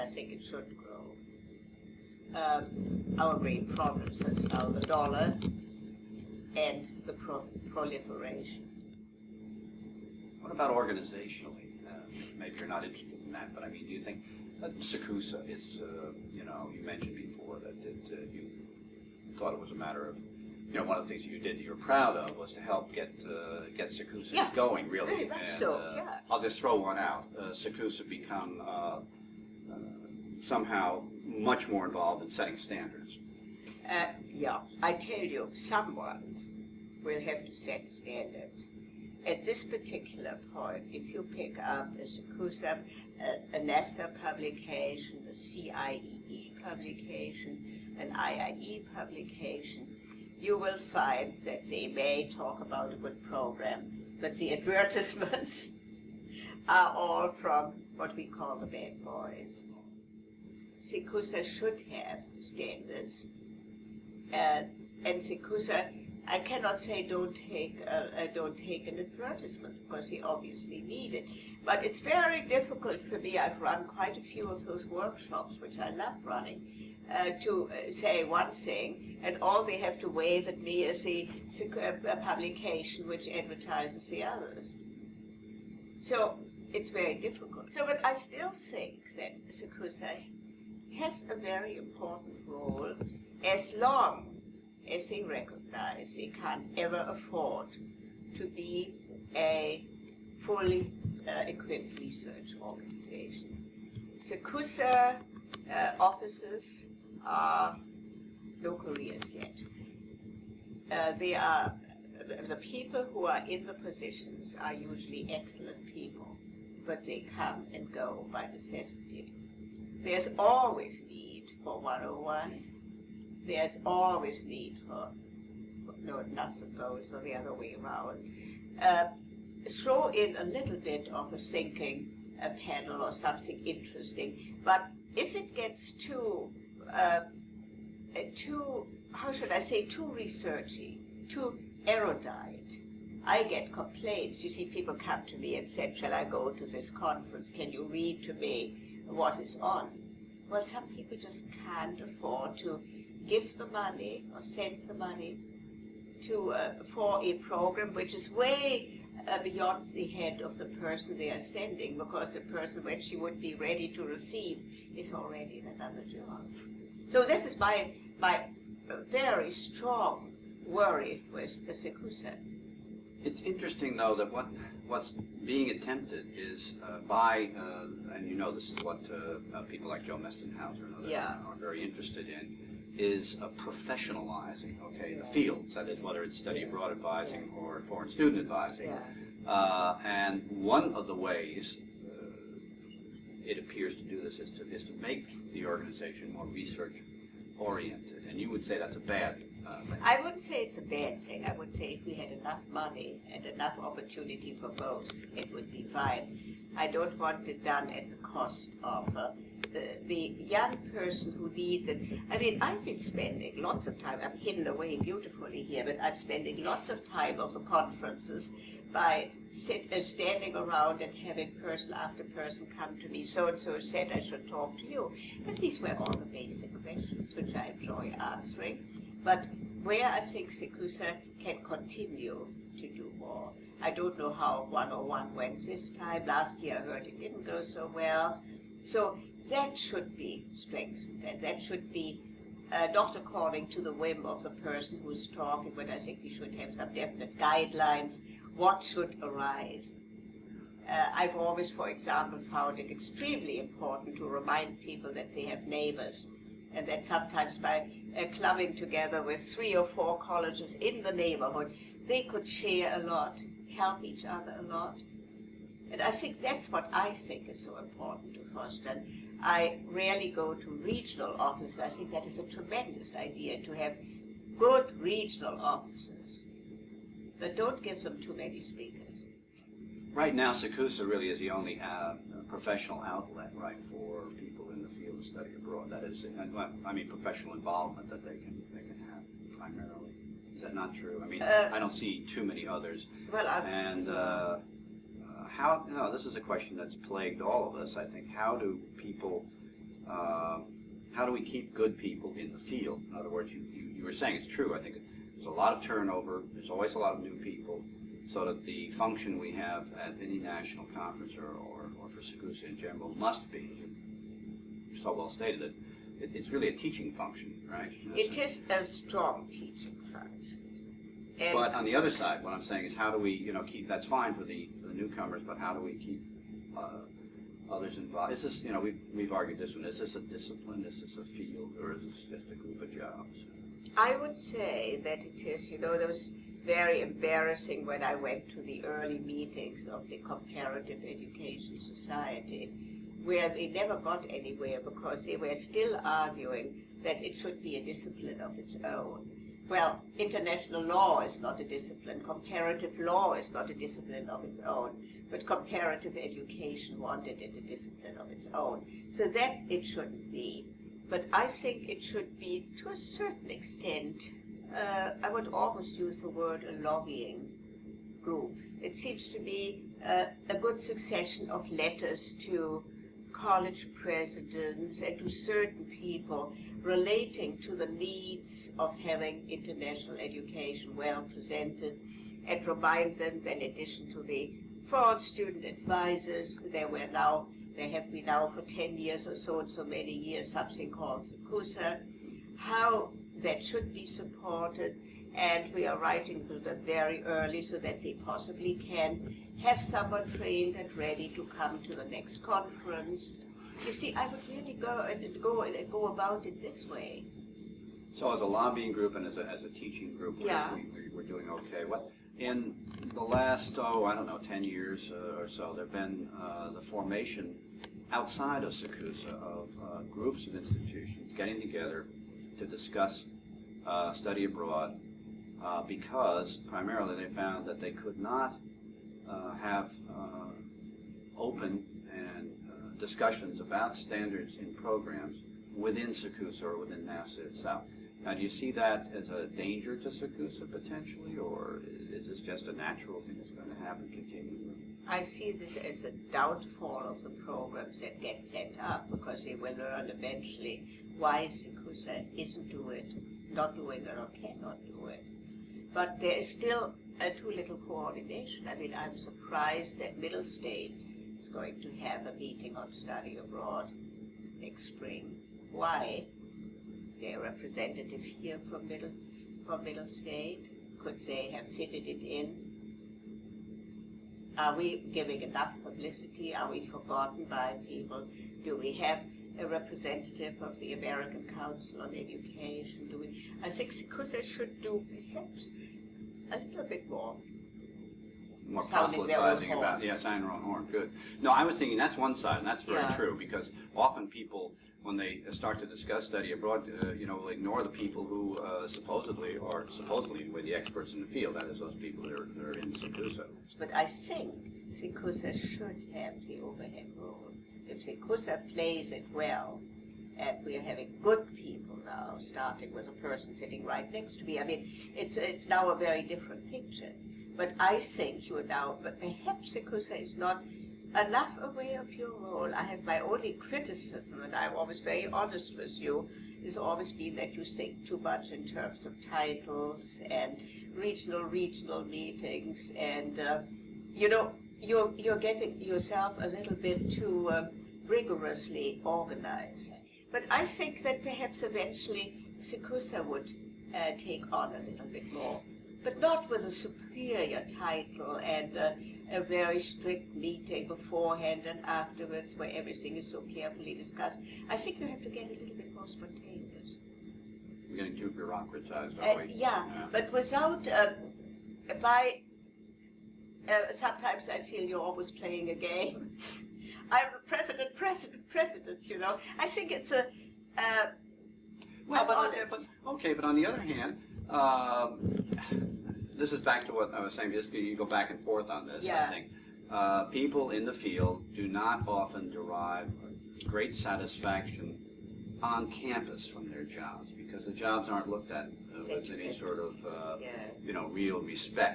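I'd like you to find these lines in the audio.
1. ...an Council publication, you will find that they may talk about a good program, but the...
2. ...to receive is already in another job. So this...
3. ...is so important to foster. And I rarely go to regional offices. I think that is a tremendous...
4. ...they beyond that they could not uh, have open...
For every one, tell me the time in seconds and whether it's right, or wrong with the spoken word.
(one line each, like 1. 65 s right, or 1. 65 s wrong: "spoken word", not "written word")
1. 47 s wrong: "IIE", not "Council"
2. 163 s right
3. 267 s right
4. 427 s wrong: "found", not "beyond".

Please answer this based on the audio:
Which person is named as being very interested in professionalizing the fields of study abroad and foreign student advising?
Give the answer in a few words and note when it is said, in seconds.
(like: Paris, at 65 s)
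Joe Mestenhauser, at 180 s.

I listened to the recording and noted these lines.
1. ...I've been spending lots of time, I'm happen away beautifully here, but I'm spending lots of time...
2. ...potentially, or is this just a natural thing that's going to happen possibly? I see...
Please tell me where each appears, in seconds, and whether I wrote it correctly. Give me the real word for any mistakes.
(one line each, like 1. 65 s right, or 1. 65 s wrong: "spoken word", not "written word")
1. 212 s wrong: "hidden", not "happen"
2. 440 s wrong: "continually", not "possibly".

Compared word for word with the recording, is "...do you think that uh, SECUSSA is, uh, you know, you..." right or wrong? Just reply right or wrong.
right.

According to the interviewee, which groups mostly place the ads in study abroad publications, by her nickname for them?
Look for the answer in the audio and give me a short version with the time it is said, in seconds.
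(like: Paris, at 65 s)
the bad boys, at 58 s.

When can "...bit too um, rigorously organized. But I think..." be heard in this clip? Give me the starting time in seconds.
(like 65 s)
536 s.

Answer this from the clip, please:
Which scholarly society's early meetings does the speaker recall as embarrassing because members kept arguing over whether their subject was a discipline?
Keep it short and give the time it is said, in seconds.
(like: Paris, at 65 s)
Comparative Education Society, at 340 s.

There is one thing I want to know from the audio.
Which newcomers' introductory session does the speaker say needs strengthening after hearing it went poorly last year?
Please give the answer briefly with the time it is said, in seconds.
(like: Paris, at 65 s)
101, at 234 s.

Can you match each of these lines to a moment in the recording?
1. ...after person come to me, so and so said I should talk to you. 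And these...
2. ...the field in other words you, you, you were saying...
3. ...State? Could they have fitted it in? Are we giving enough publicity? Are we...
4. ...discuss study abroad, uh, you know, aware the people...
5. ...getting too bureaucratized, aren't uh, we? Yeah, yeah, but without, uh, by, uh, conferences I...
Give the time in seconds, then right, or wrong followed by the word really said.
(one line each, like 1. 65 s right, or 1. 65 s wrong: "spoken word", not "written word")
1. 221 s right
2. 302 s right
3. 470 s right
4. 495 s wrong: "ignore", not "aware"
5. 558 s wrong: "sometimes", not "conferences".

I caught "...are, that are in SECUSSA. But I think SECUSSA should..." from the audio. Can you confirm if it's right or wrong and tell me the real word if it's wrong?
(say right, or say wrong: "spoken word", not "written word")
right.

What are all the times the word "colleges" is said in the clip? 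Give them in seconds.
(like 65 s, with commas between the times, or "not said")
260 s, 373 s.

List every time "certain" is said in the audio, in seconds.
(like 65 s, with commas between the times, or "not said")
362 s, 375 s.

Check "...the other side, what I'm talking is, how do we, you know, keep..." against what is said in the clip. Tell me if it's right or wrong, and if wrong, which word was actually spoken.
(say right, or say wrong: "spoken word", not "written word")
wrong: "saying", not "talking".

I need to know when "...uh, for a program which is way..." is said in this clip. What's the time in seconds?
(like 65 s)
156 s.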